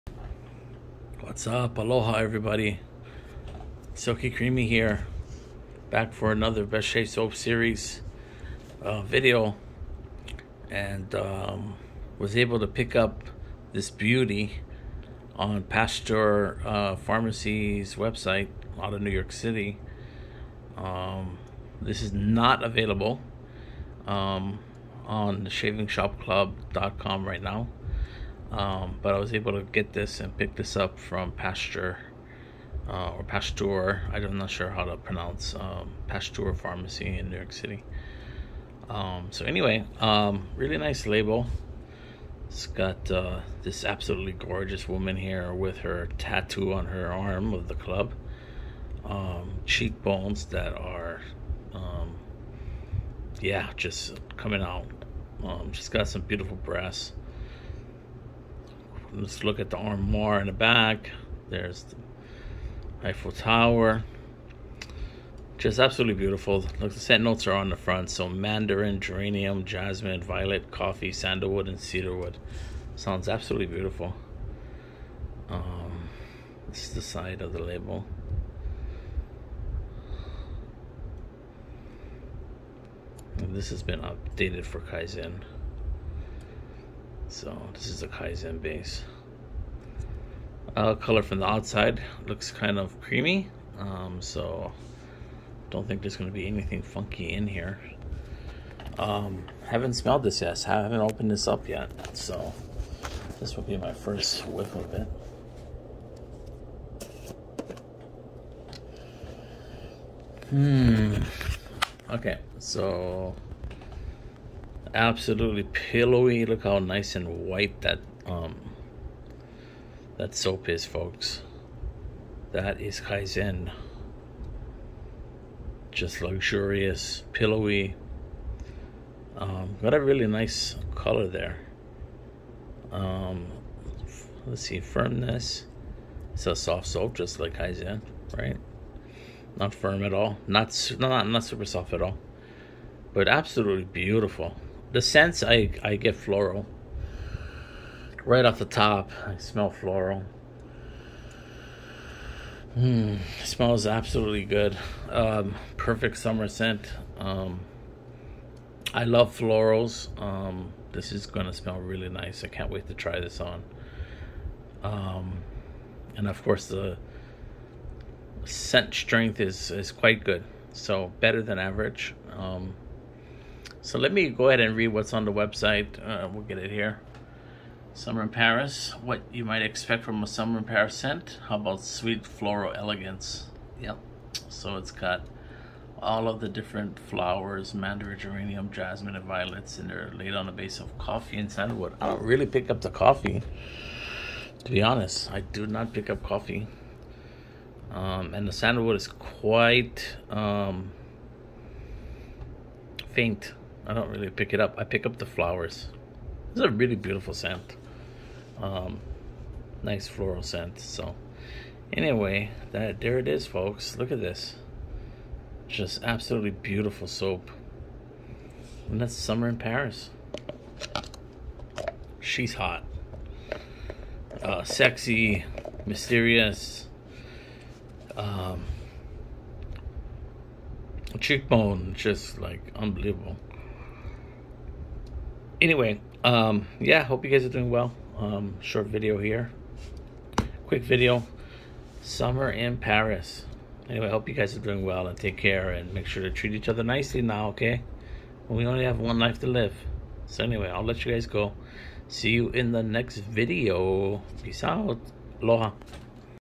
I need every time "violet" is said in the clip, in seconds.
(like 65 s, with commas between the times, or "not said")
70 s, 189 s.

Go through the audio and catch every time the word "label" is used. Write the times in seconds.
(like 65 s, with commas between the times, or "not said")
41 s, 77 s.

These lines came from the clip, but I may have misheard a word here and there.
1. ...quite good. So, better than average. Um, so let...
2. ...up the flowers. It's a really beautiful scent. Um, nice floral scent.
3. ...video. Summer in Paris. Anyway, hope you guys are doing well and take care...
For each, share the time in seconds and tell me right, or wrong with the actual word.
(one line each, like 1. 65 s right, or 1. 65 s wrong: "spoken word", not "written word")
1. 169 s right
2. 205 s right
3. 240 s right.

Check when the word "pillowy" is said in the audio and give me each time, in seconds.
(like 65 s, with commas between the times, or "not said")
115 s, 127 s.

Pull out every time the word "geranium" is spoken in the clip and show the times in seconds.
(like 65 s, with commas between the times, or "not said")
68 s, 188 s.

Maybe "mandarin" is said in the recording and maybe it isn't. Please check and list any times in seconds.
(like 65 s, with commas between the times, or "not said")
68 s, 187 s.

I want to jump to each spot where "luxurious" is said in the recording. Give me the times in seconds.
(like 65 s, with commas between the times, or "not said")
126 s.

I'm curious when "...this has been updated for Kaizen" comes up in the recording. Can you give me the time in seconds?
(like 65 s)
83 s.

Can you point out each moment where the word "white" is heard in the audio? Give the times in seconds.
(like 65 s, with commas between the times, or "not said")
117 s.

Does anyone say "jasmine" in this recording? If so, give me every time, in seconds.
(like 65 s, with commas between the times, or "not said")
69 s, 188 s.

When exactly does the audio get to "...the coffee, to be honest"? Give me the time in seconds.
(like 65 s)
192 s.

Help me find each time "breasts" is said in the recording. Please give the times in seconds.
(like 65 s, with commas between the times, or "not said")
56 s.